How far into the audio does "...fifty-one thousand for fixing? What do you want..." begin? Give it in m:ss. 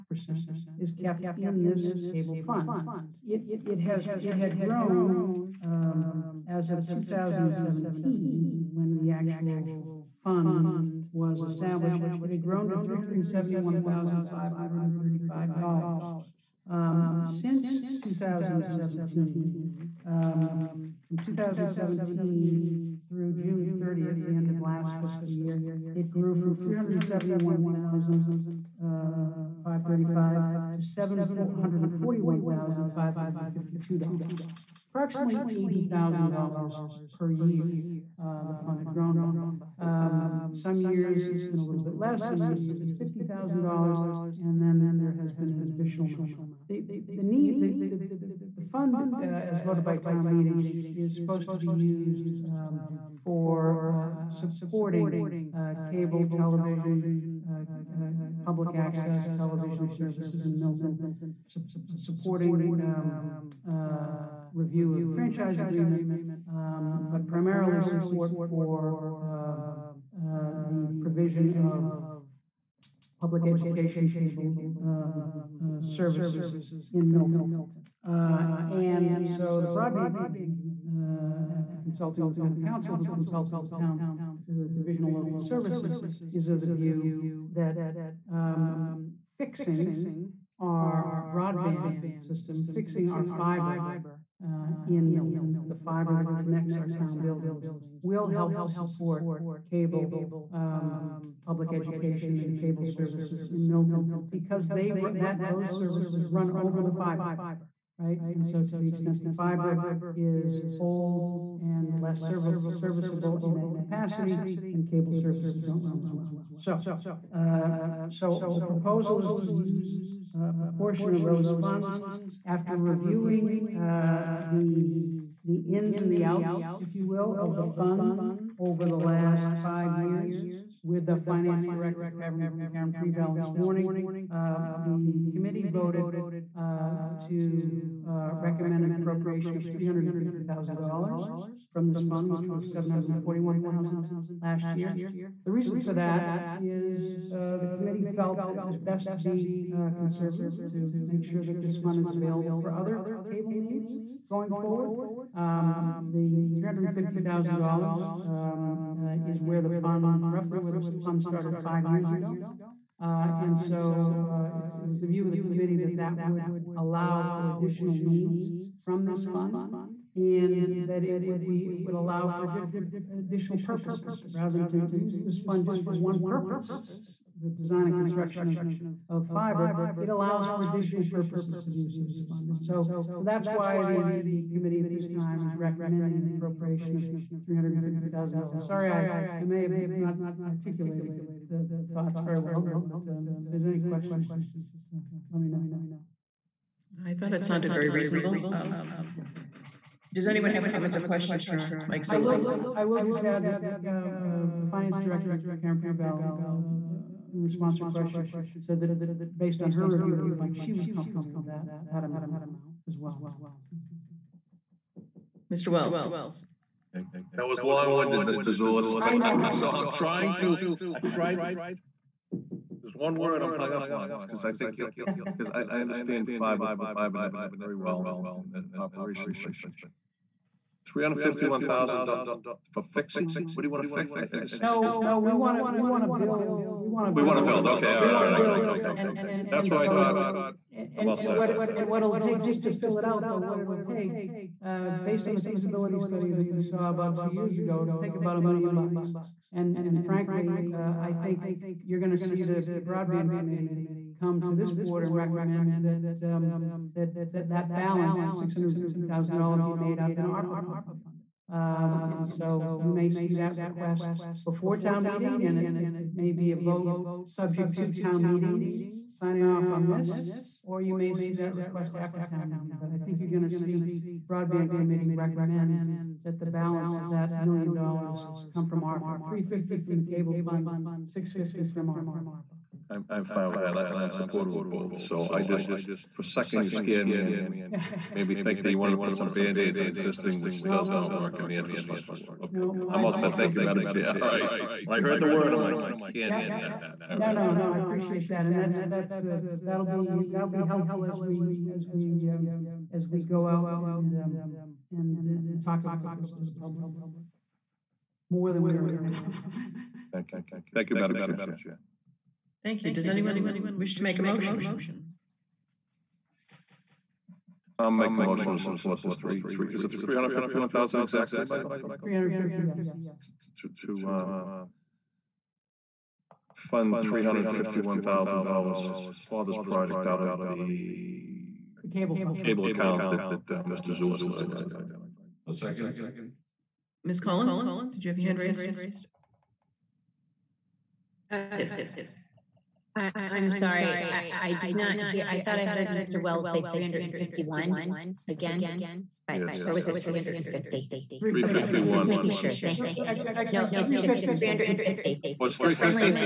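3:51.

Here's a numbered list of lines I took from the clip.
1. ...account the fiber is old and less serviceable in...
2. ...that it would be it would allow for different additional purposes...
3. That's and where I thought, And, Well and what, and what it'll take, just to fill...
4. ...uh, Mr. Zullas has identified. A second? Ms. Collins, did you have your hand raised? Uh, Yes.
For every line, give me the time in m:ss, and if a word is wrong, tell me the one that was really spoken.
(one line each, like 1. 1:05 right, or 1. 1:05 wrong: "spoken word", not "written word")
1. 1:48 wrong: "extent", not "account"
2. 2:50 right
3. 3:59 right
4. 5:33 right.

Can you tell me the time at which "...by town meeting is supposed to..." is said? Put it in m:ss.
0:49.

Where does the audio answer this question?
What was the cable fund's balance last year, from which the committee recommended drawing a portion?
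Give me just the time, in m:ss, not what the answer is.
2:22.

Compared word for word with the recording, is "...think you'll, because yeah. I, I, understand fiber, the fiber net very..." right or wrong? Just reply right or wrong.
right.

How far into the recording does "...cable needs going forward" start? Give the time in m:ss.
2:33.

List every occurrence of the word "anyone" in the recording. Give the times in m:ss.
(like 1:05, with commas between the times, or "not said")
3:20, 5:13.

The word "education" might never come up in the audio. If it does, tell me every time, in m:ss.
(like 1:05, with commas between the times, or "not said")
1:13, 1:41.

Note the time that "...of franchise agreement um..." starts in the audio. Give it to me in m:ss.
1:04.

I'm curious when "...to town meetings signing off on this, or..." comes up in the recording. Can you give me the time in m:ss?
4:27.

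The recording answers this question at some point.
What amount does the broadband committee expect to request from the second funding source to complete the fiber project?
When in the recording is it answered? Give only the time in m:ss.
4:18.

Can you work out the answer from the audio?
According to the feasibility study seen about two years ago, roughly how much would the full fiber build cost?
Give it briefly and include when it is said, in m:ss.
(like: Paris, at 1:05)
about a million bucks, at 4:08.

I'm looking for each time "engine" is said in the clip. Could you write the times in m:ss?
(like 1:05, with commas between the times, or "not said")
not said.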